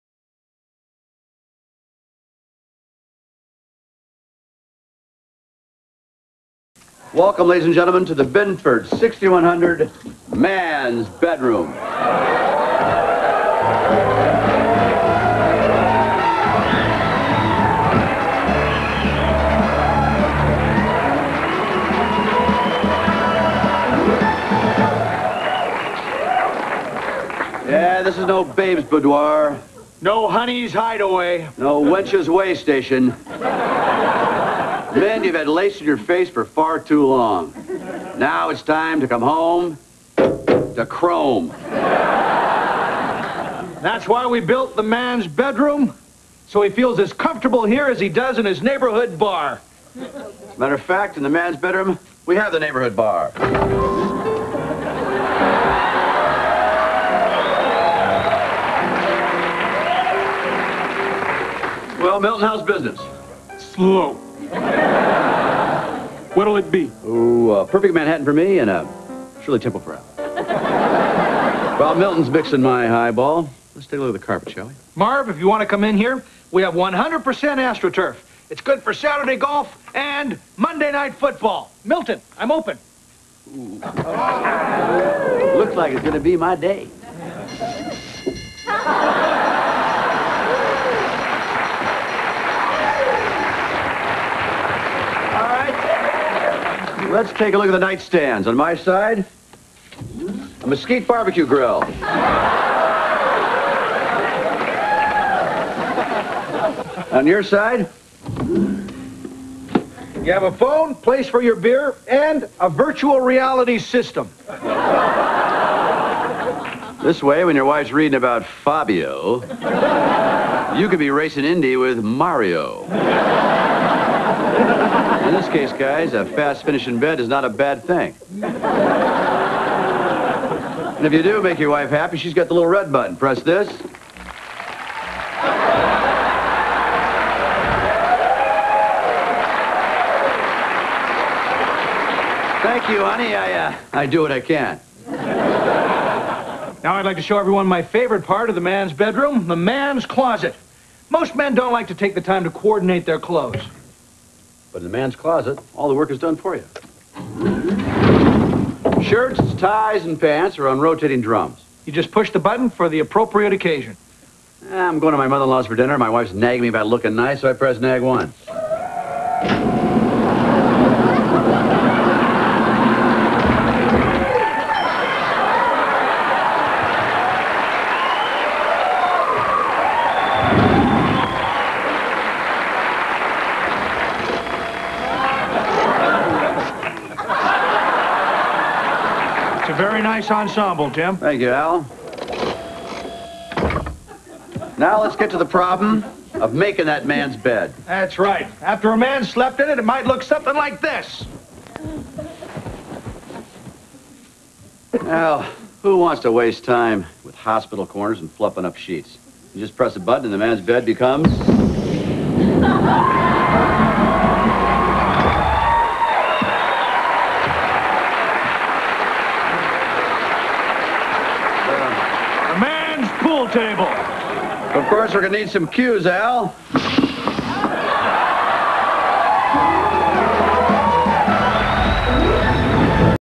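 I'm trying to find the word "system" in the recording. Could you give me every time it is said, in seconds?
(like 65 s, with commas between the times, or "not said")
113 s.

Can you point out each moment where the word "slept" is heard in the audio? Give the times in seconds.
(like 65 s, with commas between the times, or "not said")
199 s.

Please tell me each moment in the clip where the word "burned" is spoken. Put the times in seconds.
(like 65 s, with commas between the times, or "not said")
not said.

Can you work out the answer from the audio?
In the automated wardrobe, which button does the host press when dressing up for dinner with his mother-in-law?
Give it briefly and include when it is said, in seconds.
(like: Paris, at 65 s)
Nag one, at 167 s.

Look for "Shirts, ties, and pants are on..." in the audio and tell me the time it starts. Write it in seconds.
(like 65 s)
159 s.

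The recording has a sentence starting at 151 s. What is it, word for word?
Most men don't like to take the time to coordinate their clothes.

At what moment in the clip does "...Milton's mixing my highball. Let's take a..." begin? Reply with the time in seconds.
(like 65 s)
71 s.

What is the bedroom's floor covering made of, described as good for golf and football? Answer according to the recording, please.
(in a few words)
AstroTurf.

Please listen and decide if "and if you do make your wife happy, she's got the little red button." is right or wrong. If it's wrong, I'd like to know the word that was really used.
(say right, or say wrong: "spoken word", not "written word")
right.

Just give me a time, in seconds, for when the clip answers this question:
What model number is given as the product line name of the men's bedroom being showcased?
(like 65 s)
8 s.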